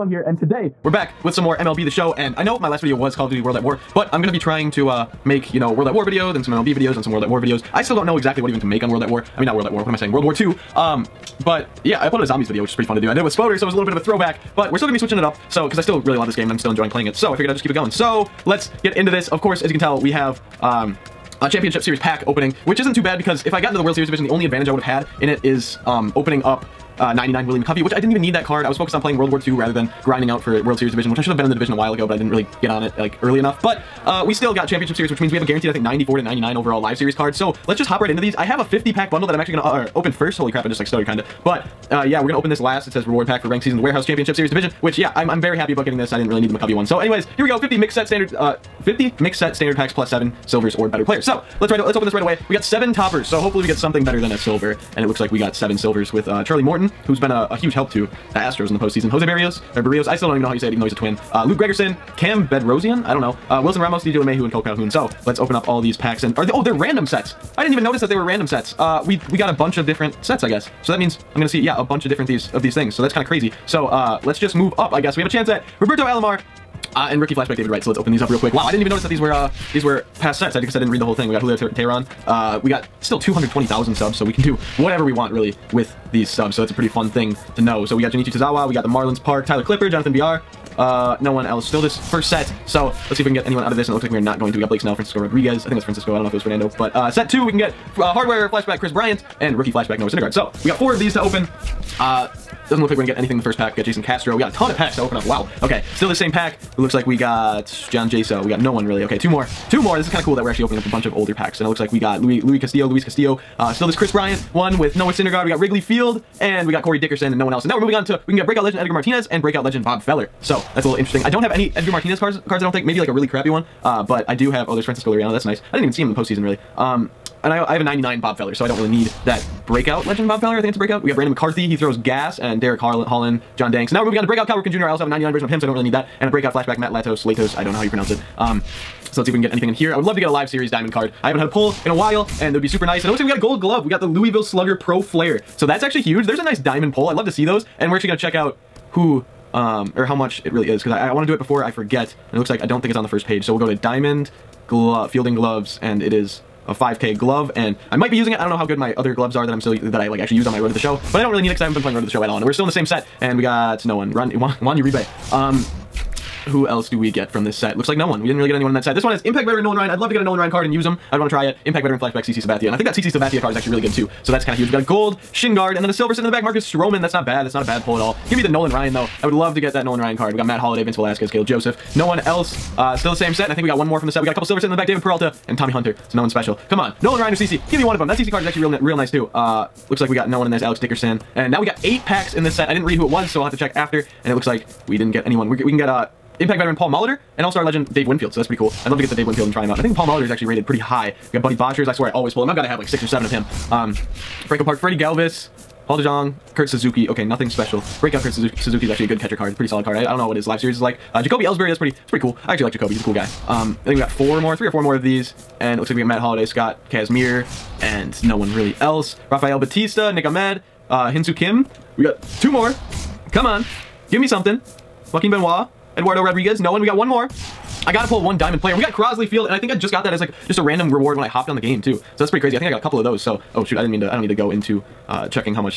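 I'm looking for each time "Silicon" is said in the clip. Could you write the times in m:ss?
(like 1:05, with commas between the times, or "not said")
not said.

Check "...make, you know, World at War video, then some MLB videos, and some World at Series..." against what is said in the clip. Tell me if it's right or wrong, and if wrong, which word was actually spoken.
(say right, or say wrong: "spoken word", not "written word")
wrong: "War", not "Series".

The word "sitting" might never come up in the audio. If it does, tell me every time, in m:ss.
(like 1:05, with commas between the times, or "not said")
2:56, 3:04.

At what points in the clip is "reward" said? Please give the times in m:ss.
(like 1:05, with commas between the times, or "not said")
0:43, 3:50.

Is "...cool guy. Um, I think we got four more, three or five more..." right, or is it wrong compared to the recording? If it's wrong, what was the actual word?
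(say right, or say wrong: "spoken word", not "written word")
wrong: "four", not "five".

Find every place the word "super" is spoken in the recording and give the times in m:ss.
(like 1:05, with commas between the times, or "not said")
2:22.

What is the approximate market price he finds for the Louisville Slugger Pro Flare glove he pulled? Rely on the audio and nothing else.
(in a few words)
5k.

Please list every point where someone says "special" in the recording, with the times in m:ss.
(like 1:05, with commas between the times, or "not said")
3:06, 3:27.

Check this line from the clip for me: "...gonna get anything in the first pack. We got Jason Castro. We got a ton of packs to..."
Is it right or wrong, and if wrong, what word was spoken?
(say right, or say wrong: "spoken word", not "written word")
right.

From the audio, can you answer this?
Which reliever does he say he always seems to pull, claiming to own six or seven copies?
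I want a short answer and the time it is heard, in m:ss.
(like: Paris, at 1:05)
Buddy Boshers, at 3:21.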